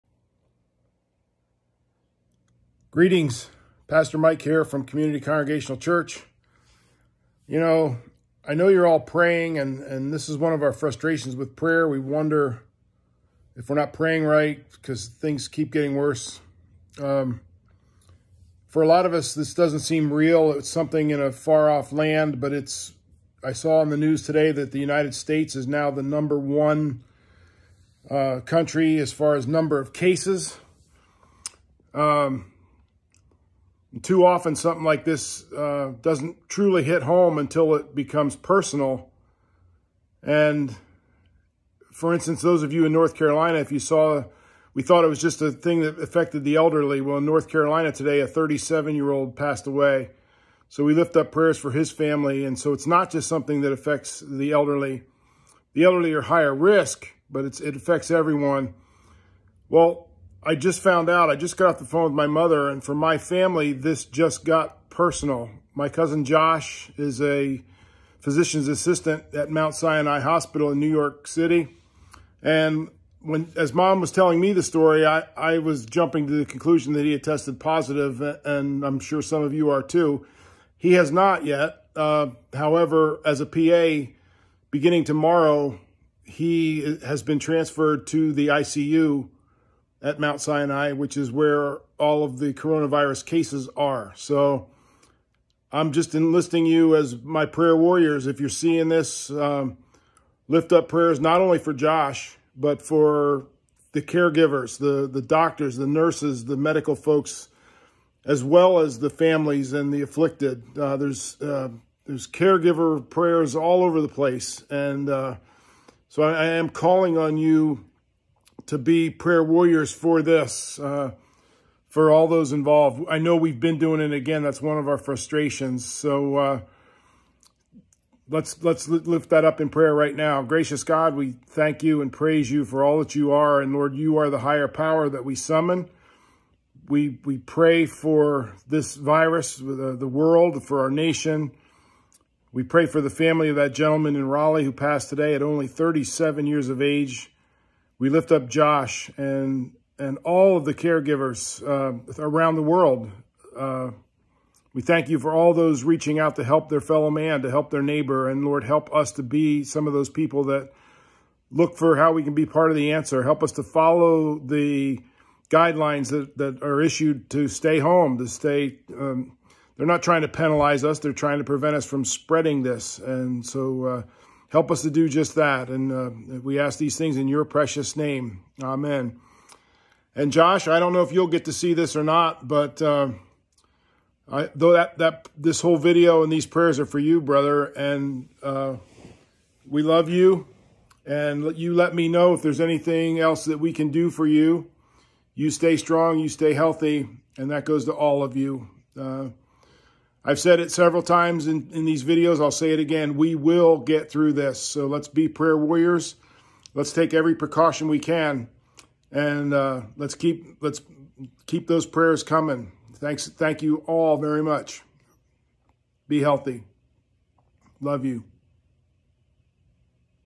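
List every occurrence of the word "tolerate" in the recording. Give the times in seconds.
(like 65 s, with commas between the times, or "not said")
not said.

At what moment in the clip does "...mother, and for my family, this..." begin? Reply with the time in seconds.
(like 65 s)
62 s.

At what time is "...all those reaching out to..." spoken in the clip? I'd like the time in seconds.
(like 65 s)
155 s.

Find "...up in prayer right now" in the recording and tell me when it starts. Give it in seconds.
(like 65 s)
129 s.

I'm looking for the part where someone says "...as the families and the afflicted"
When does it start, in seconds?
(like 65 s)
108 s.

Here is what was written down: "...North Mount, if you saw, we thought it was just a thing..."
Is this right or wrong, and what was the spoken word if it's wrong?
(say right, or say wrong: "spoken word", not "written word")
wrong: "Carolina", not "Mount".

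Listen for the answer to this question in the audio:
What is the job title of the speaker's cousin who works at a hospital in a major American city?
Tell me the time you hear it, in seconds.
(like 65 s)
68 s.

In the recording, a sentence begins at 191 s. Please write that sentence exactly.
And you let me know if there's anything else that we can do for you.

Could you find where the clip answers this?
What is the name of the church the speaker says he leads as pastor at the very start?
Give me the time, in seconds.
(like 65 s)
4 s.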